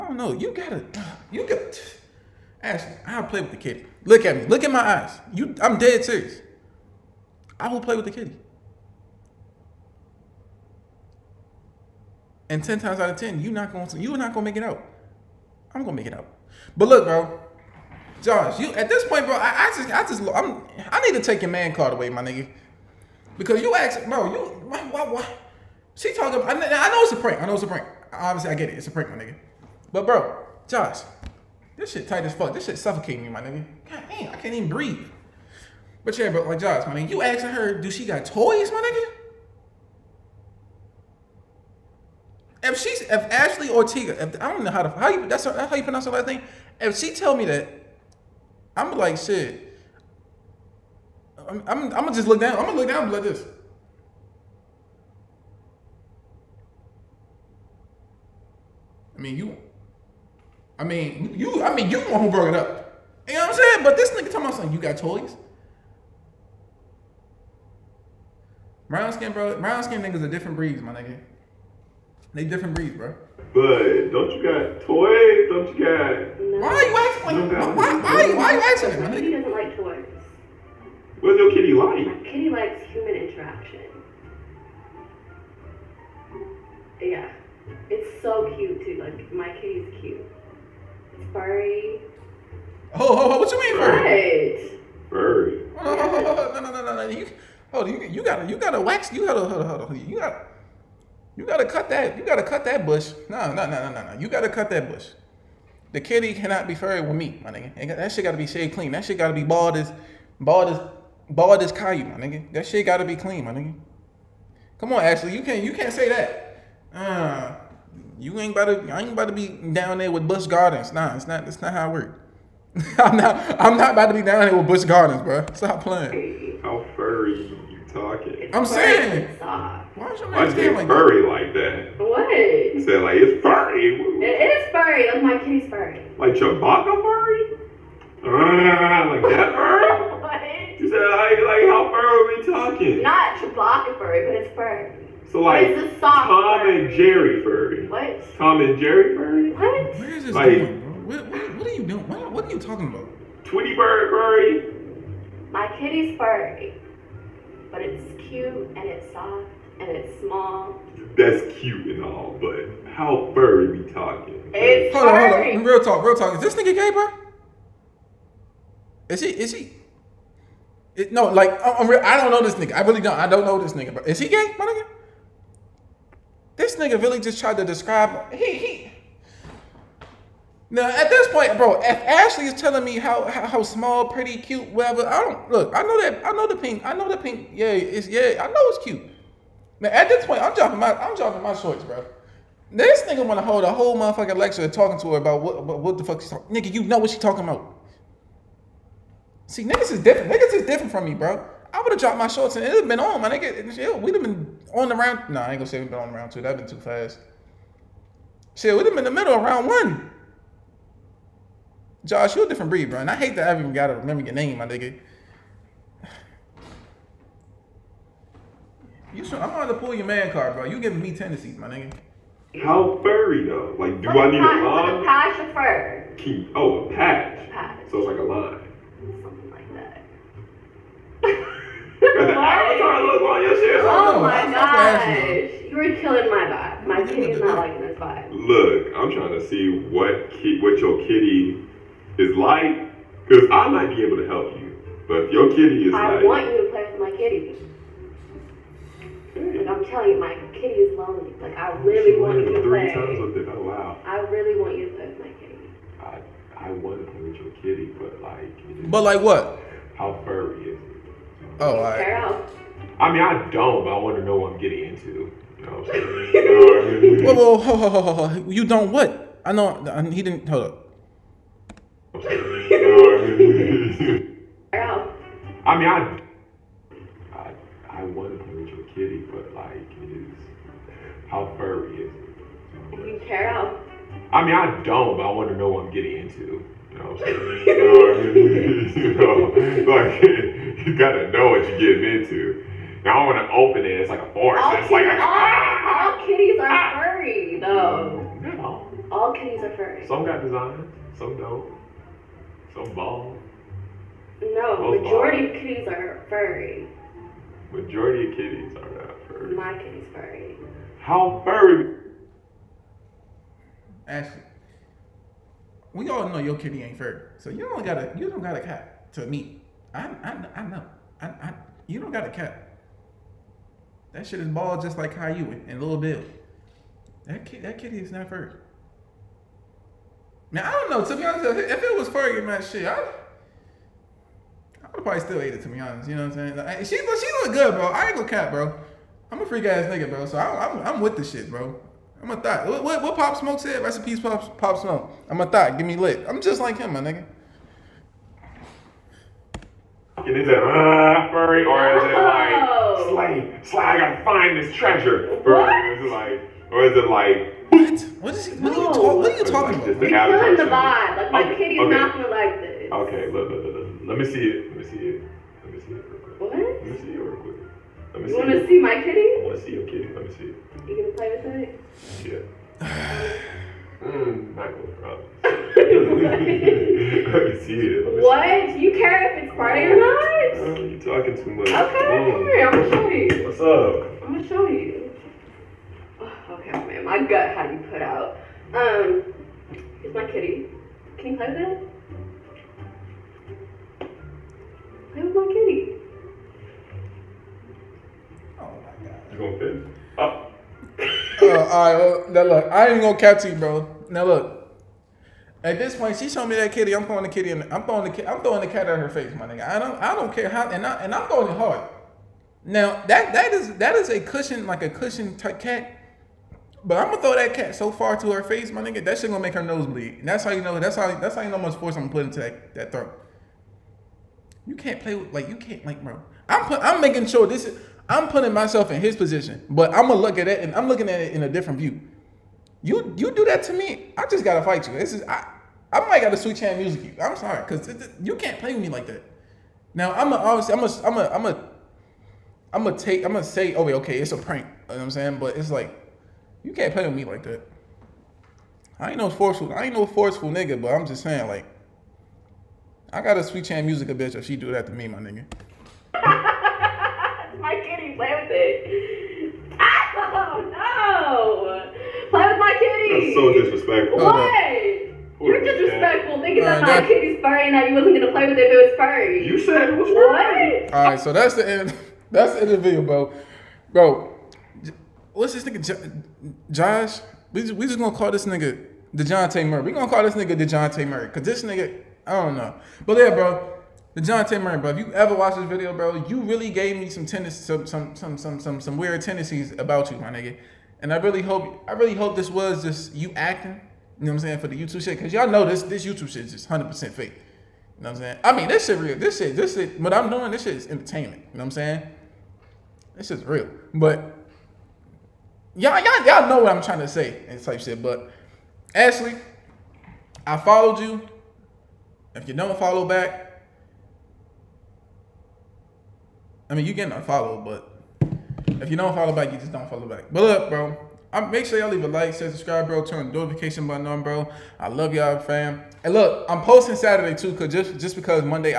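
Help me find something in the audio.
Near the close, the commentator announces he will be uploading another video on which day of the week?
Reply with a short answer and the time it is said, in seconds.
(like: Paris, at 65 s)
Saturday, at 526 s.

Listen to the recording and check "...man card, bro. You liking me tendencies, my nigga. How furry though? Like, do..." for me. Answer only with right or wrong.
wrong.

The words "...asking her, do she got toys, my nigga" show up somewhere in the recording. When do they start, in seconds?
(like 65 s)
37 s.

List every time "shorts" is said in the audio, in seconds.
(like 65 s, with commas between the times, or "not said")
191 s, 202 s.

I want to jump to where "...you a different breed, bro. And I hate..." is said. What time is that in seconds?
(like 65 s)
212 s.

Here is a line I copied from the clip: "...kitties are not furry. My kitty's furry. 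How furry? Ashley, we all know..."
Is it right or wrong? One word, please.
right.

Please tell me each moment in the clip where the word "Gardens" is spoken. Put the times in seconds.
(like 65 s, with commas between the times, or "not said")
120 s, 124 s.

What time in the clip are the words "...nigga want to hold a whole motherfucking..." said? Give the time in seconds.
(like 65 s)
193 s.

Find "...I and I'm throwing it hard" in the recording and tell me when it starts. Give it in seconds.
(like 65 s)
410 s.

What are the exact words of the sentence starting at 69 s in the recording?
Brown skin niggas are different breeds, my nigga.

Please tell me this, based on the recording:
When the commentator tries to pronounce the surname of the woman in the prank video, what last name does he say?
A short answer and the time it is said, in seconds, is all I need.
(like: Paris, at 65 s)
Ortega, at 43 s.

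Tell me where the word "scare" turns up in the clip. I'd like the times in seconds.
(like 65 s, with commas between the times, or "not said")
not said.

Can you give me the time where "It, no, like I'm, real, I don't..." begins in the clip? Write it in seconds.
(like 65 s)
170 s.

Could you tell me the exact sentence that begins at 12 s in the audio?
And ten times out of ten, you not going to, you are not gonna make it out.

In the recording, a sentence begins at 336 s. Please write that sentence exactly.
she look, she look good, bro.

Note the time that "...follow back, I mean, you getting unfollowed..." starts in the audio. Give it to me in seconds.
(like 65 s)
512 s.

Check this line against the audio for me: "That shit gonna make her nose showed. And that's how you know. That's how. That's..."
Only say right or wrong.
wrong.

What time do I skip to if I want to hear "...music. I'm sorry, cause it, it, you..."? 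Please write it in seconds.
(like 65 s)
436 s.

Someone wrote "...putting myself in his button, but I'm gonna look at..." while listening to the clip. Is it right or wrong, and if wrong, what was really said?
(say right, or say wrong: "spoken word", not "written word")
wrong: "position", not "button".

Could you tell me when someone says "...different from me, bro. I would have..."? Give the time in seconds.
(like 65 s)
200 s.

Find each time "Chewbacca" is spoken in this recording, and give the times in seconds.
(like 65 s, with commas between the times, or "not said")
136 s, 143 s.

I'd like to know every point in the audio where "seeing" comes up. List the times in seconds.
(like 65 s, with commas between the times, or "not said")
not said.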